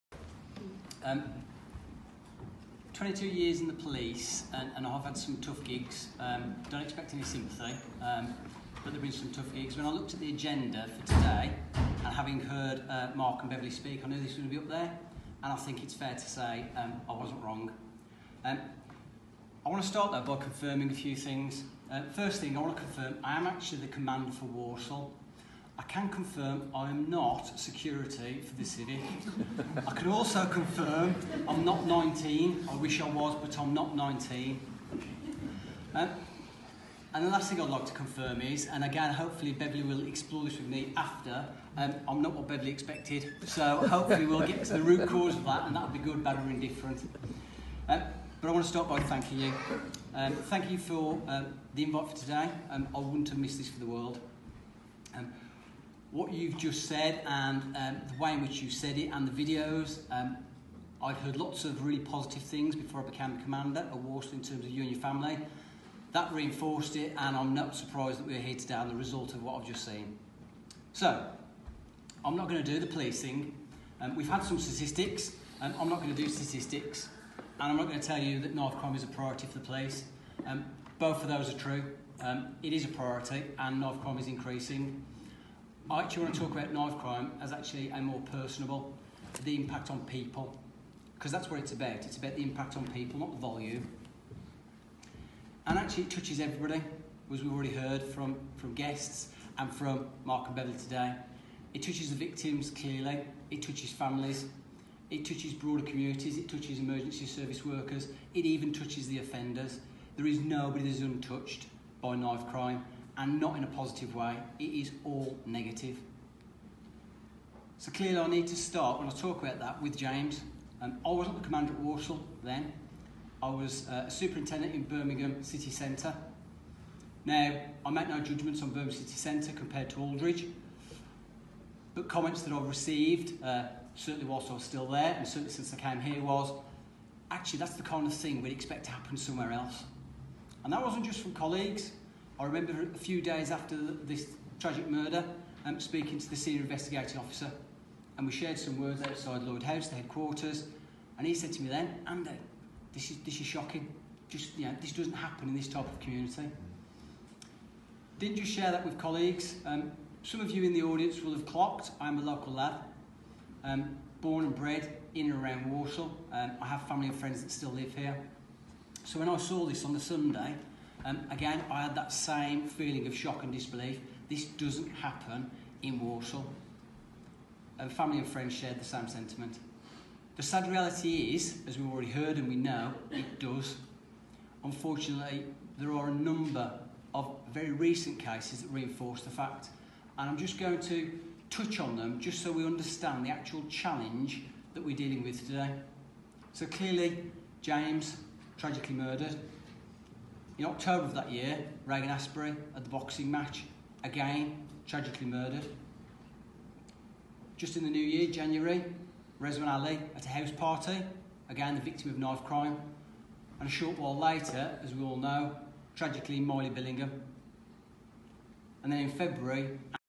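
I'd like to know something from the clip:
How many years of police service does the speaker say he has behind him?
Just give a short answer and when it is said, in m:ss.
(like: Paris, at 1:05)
22, at 0:02.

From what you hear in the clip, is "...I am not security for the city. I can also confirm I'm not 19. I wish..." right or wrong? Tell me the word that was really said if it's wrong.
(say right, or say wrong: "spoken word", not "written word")
right.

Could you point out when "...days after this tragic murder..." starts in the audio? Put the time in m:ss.
2:23.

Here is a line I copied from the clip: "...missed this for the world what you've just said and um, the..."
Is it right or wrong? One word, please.
right.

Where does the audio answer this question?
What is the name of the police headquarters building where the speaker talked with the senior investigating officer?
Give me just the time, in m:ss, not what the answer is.
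2:29.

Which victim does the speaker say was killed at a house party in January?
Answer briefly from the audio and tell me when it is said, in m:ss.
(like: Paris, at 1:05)
Rezwan Ali, at 3:29.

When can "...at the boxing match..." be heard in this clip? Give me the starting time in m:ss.
3:22.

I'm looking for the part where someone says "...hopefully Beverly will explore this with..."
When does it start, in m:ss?
0:39.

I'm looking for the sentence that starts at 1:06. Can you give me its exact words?
That reinforced it, and I'm not surprised that we're here today on the result of what I've just seen.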